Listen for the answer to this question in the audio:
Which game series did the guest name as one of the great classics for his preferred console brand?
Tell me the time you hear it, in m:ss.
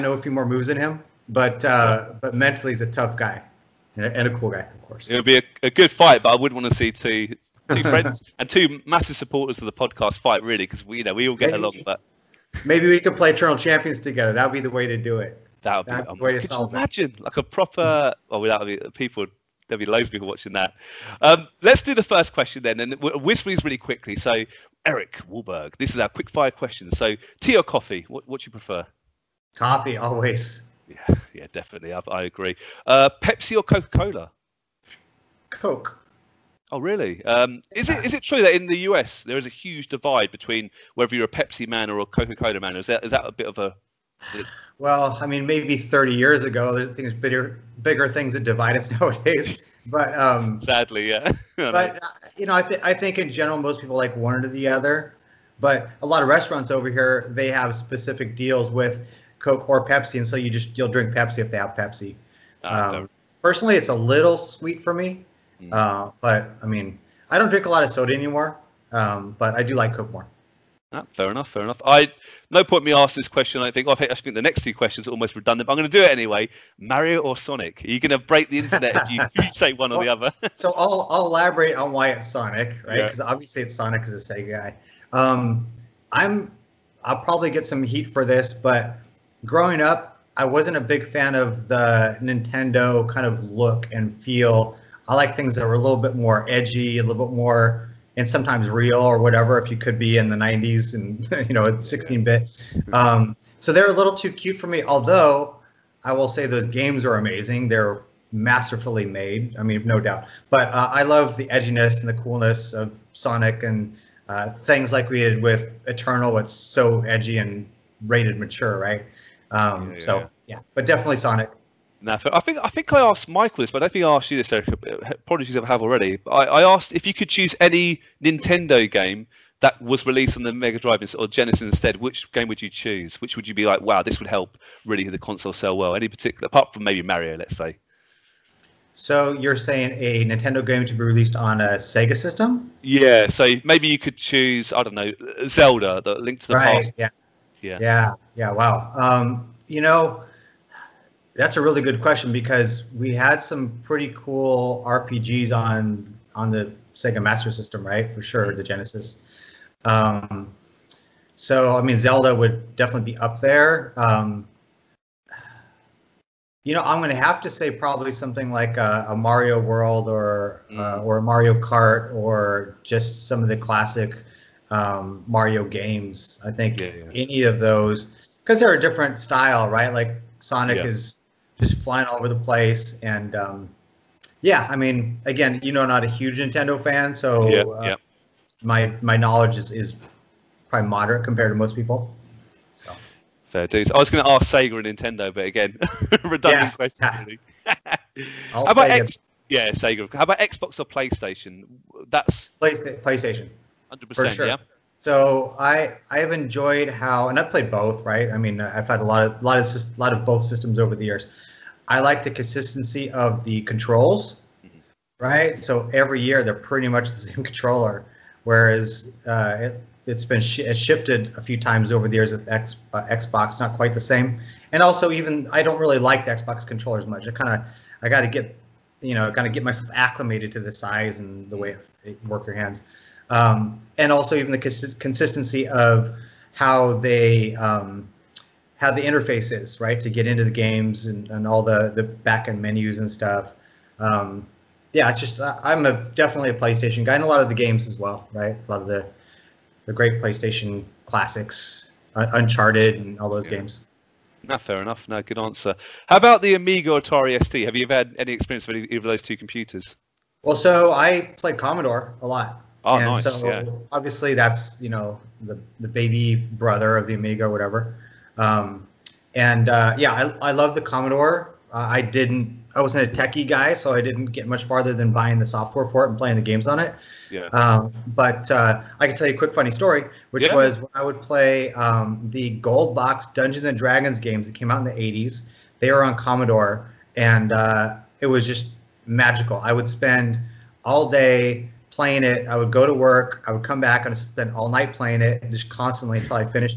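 4:12.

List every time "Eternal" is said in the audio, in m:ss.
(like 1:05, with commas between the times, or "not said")
0:13, 1:55.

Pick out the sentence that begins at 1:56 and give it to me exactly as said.
It's so edgy and rated mature, right?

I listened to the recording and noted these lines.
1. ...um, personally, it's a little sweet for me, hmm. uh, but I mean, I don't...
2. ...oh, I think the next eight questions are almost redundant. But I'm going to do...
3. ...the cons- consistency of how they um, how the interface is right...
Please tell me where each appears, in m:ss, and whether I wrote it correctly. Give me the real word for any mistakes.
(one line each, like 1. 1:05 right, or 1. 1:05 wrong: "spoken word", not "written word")
1. 1:02 right
2. 1:13 wrong: "two", not "eight"
3. 3:54 right.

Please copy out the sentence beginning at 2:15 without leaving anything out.
Any particular, apart from maybe Mario, let's say.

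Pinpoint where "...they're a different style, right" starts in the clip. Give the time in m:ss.
2:58.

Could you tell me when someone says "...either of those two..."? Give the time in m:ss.
4:18.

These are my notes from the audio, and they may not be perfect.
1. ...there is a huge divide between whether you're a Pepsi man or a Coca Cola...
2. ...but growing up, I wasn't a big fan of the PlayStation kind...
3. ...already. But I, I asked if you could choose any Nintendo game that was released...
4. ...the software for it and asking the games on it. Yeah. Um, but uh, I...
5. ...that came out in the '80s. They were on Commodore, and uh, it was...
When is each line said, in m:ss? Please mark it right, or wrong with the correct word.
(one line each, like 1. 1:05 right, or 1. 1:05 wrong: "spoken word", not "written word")
1. 0:39 right
2. 1:28 wrong: "Nintendo", not "PlayStation"
3. 2:05 right
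4. 4:35 wrong: "playing", not "asking"
5. 4:44 right.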